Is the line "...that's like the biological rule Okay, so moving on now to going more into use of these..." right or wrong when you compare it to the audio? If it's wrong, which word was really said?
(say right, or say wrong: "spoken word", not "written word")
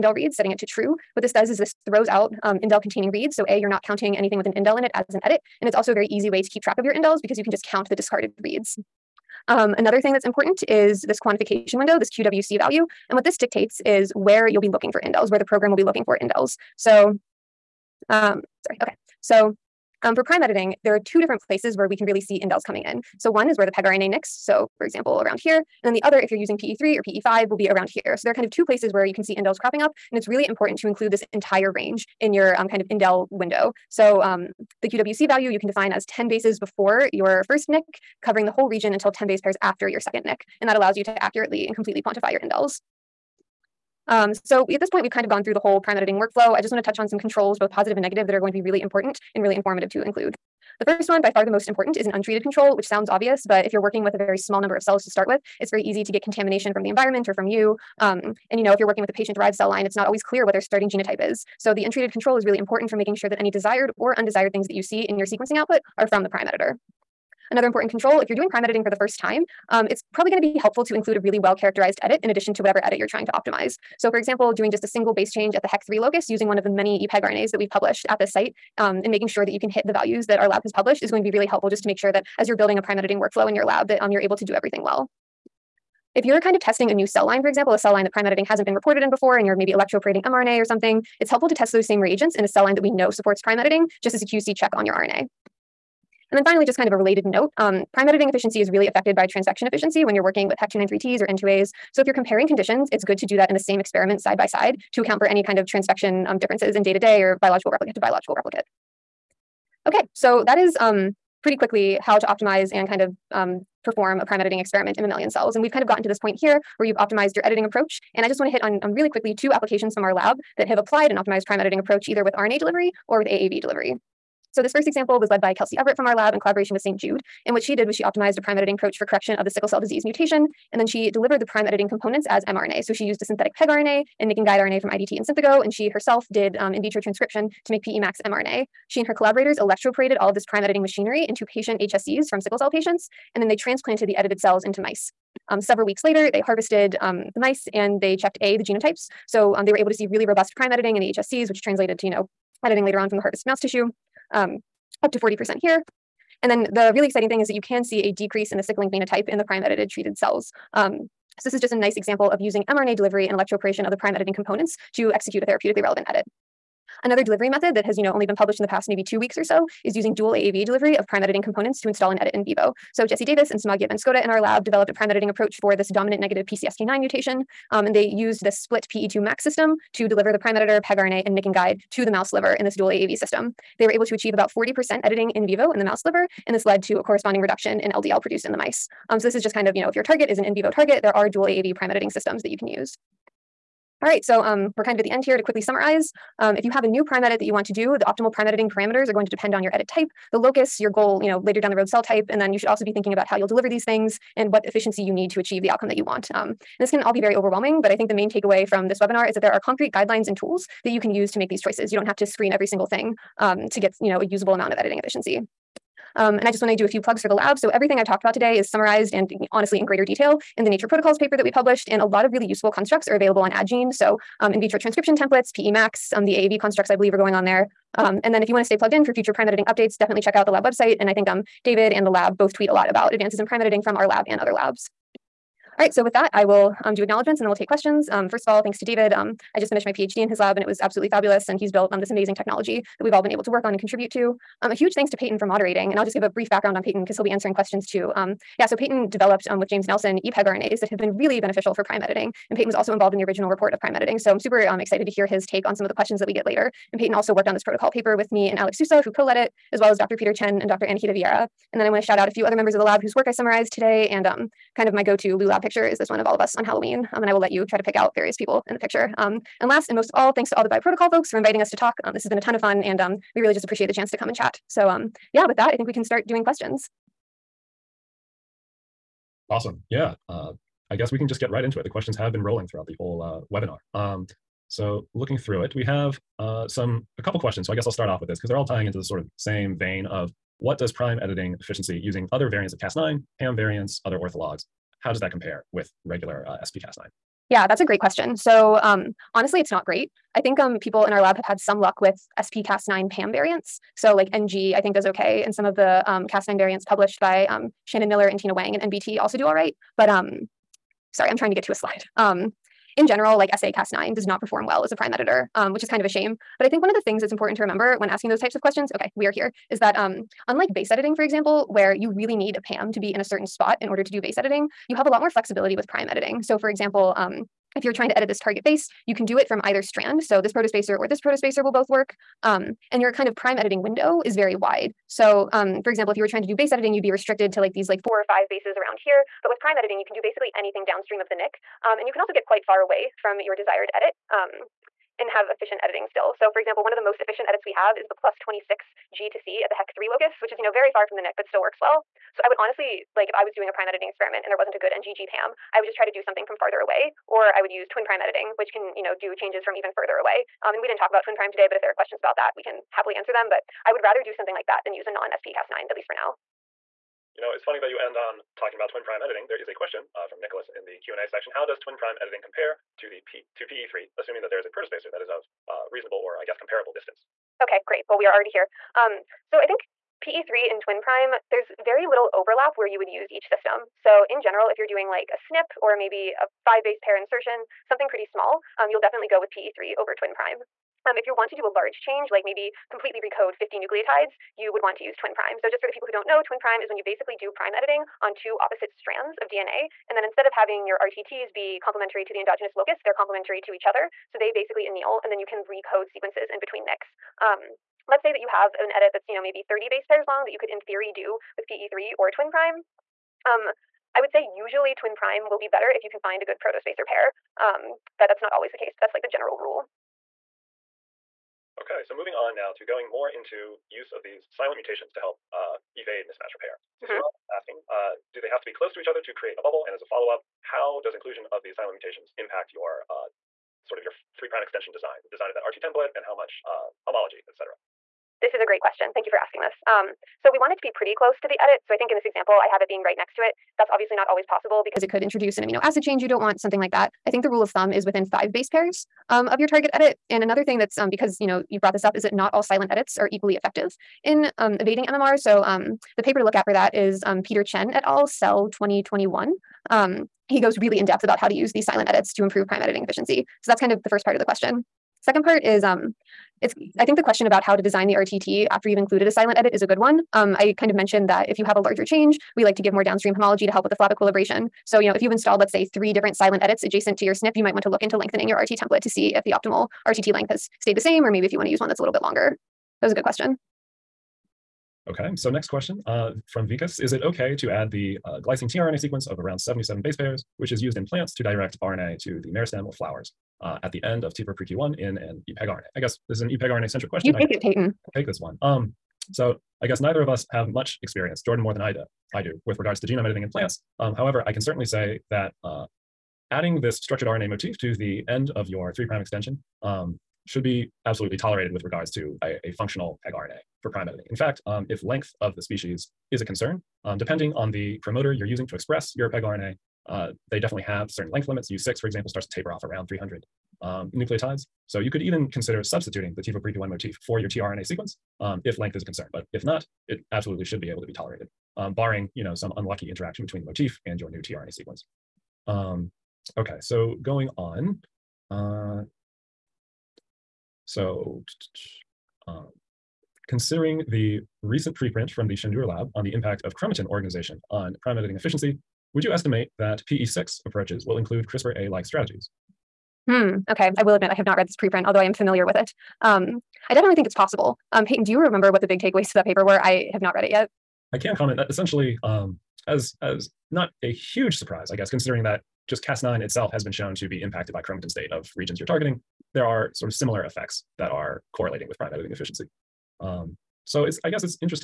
wrong: "general", not "biological".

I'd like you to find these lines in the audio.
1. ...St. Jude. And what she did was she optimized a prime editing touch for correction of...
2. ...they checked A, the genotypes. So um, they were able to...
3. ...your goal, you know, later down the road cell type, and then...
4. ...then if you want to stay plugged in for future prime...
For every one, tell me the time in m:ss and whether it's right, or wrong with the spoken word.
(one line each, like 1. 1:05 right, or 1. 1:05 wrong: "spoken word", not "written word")
1. 2:06 wrong: "approach", not "touch"
2. 2:28 right
3. 3:20 right
4. 3:48 right.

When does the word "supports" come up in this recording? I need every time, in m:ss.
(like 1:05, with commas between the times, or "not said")
1:33.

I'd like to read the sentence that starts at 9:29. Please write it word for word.
There are sort of similar effects that are correlating with prime editing efficiency.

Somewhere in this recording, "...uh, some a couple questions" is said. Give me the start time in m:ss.
4:46.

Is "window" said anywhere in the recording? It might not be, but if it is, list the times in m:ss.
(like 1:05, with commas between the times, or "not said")
0:11, 0:33, 5:33.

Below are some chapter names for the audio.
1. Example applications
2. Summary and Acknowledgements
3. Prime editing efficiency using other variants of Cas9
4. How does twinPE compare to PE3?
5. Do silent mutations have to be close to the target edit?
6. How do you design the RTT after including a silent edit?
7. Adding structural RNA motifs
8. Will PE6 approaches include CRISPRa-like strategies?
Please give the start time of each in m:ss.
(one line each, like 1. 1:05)
1. 1:50
2. 3:13
3. 4:44
4. 6:07
5. 7:01
6. 7:44
7. 8:04
8. 9:02.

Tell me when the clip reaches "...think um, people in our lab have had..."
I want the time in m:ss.
5:00.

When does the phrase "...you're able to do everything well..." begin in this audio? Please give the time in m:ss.
1:24.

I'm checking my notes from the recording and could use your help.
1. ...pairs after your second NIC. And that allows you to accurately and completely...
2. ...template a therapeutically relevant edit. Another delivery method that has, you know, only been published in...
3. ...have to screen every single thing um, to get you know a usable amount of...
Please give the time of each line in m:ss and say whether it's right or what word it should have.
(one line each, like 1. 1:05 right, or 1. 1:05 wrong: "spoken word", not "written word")
1. 0:39 right
2. 2:45 wrong: "execute", not "template"
3. 3:32 right.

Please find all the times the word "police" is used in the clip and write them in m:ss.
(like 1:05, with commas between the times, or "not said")
not said.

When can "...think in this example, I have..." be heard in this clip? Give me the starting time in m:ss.
7:21.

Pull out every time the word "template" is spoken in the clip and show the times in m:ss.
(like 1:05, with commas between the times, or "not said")
3:45, 7:15, 7:58.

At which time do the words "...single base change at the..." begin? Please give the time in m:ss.
1:14.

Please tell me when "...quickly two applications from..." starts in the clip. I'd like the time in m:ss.
1:59.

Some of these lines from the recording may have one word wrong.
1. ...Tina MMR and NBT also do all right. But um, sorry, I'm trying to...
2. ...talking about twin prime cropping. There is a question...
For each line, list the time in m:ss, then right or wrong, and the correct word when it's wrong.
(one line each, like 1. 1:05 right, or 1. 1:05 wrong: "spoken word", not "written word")
1. 5:08 wrong: "Wang", not "MMR"
2. 6:08 wrong: "editing", not "cropping".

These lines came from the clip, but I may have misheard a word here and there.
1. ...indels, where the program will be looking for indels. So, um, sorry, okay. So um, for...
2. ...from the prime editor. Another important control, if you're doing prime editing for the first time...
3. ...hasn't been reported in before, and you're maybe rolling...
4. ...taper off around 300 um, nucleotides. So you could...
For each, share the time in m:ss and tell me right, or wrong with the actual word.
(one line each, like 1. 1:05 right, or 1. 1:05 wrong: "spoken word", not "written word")
1. 0:15 right
2. 1:06 right
3. 1:28 wrong: "electroporating", not "rolling"
4. 8:42 right.